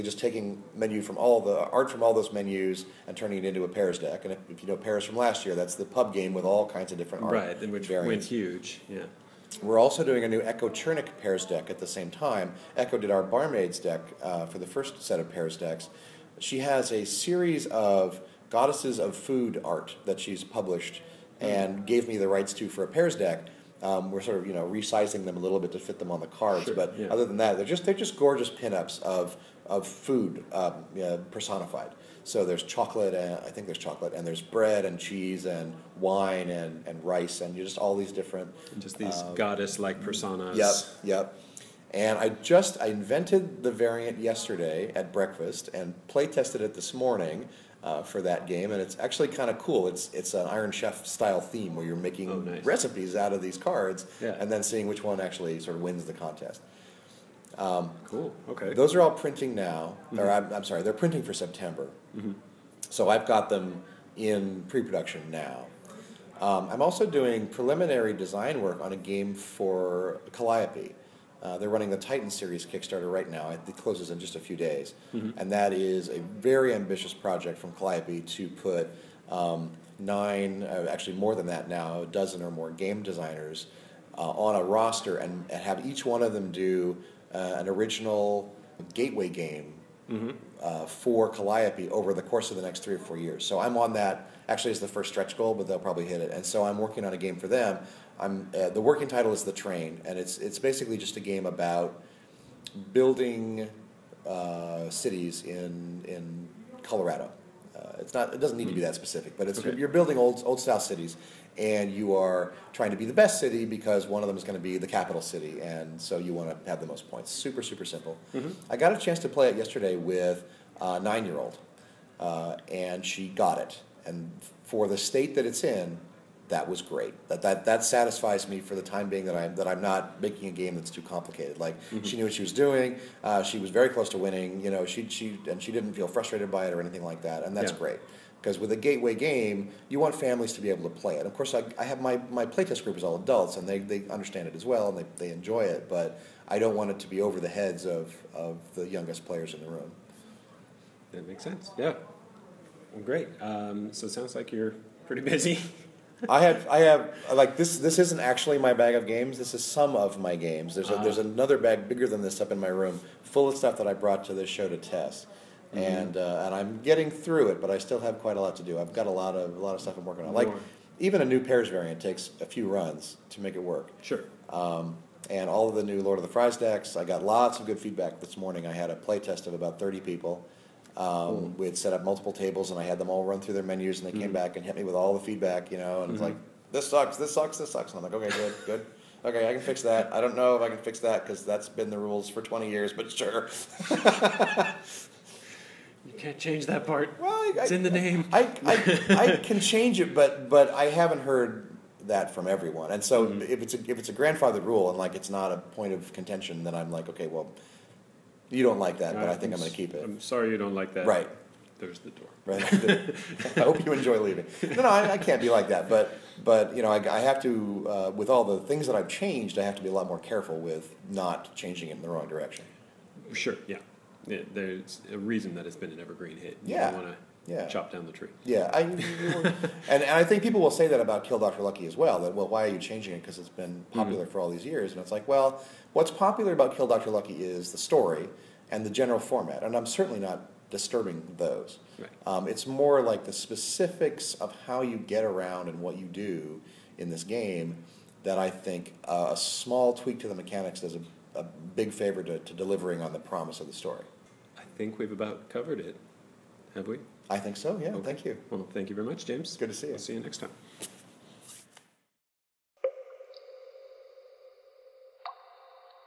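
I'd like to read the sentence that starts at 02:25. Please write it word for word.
But I don't want it to be over the heads of, of the youngest players in the room.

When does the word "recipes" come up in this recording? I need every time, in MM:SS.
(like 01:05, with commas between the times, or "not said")
00:52.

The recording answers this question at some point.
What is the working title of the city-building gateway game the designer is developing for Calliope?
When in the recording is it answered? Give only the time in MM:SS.
01:39.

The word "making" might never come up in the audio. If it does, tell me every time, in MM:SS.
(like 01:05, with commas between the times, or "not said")
00:51, 02:10.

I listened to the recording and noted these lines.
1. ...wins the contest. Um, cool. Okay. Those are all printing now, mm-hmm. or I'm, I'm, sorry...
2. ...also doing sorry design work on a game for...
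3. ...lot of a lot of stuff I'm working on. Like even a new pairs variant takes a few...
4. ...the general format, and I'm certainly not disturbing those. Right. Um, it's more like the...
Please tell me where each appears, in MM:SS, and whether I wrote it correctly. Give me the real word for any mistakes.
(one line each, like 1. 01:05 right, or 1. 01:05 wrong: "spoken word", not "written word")
1. 00:55 right
2. 01:06 wrong: "preliminary", not "sorry"
3. 02:49 right
4. 03:58 right.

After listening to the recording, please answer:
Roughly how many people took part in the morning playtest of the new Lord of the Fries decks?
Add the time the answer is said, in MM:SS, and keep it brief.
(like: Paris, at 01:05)
30, at 02:59.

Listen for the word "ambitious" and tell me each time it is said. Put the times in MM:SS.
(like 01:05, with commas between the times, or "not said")
01:16.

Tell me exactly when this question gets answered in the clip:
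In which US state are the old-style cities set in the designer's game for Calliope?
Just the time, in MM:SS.
01:46.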